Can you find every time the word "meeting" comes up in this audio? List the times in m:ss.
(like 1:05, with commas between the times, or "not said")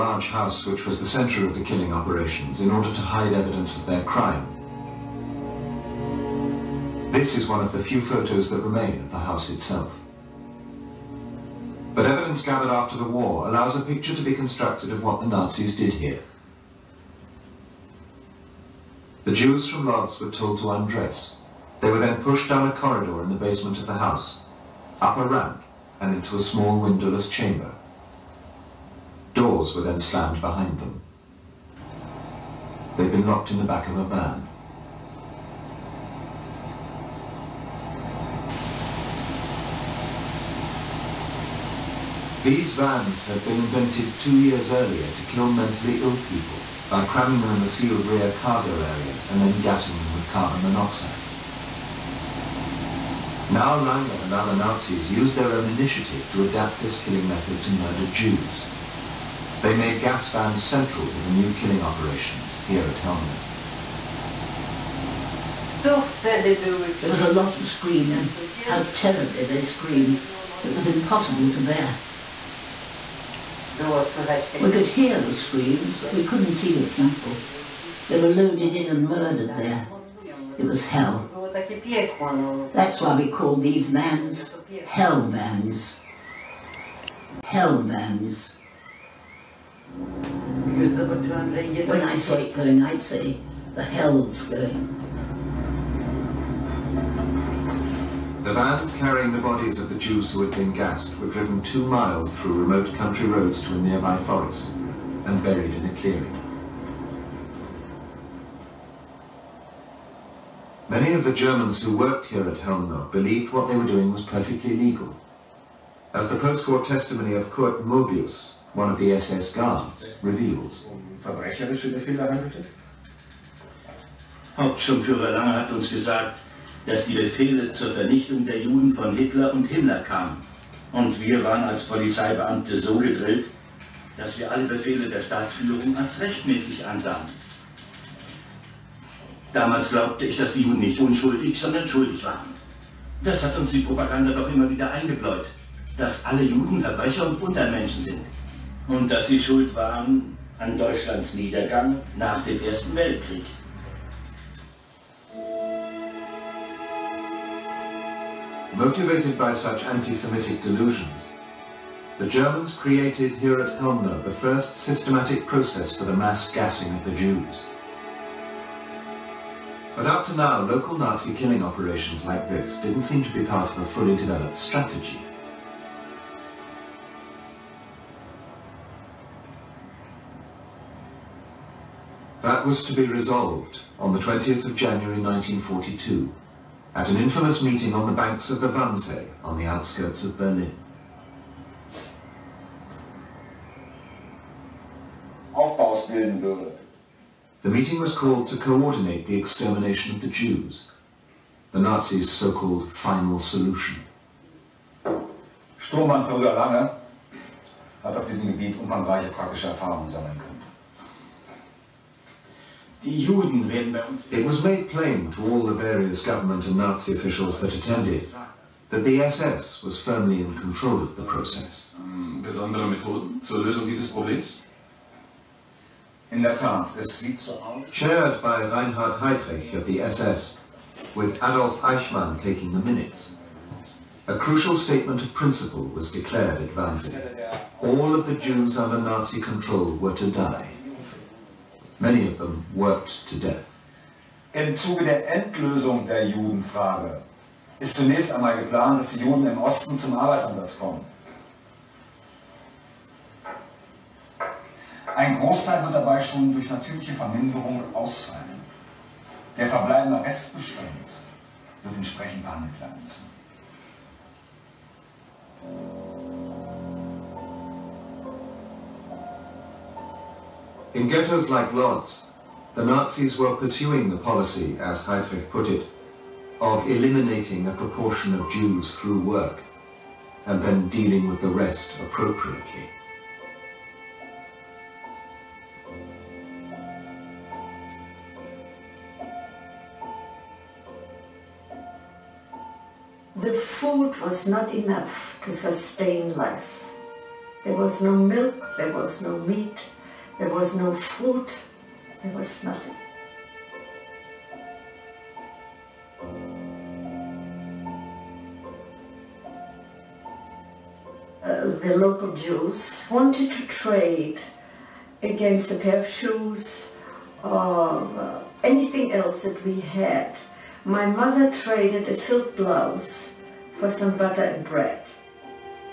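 3:07, 3:17.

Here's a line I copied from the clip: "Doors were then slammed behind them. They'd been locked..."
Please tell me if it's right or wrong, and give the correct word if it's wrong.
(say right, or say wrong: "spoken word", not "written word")
right.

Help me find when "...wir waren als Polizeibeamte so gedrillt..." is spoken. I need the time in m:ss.
2:11.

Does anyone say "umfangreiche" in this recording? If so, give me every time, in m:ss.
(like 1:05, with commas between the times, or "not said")
3:28.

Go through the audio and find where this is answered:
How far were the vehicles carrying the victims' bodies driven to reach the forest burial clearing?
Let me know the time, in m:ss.
1:41.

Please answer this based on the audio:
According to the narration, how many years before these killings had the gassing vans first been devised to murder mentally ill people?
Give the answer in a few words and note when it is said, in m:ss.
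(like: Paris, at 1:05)
2, at 0:44.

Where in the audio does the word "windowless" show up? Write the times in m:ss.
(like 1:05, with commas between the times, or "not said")
0:26.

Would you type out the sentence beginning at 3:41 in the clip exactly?
Mm, besondere Methoden zur Lösung dieses Problems?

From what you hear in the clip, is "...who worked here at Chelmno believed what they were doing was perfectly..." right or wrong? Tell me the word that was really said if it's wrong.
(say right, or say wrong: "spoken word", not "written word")
right.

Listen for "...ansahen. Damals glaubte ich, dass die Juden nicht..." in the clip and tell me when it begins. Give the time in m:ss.
2:16.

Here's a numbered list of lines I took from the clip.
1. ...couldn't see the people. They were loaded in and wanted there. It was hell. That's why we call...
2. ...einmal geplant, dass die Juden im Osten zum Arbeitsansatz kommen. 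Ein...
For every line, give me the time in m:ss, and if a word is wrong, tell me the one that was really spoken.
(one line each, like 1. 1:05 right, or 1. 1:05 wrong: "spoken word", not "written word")
1. 1:16 wrong: "murdered", not "wanted"
2. 4:08 right.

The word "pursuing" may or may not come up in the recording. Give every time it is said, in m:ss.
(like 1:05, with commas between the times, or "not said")
4:33.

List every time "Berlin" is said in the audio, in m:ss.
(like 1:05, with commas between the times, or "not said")
3:10.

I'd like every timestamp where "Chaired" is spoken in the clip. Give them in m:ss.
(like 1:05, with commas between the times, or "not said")
3:47.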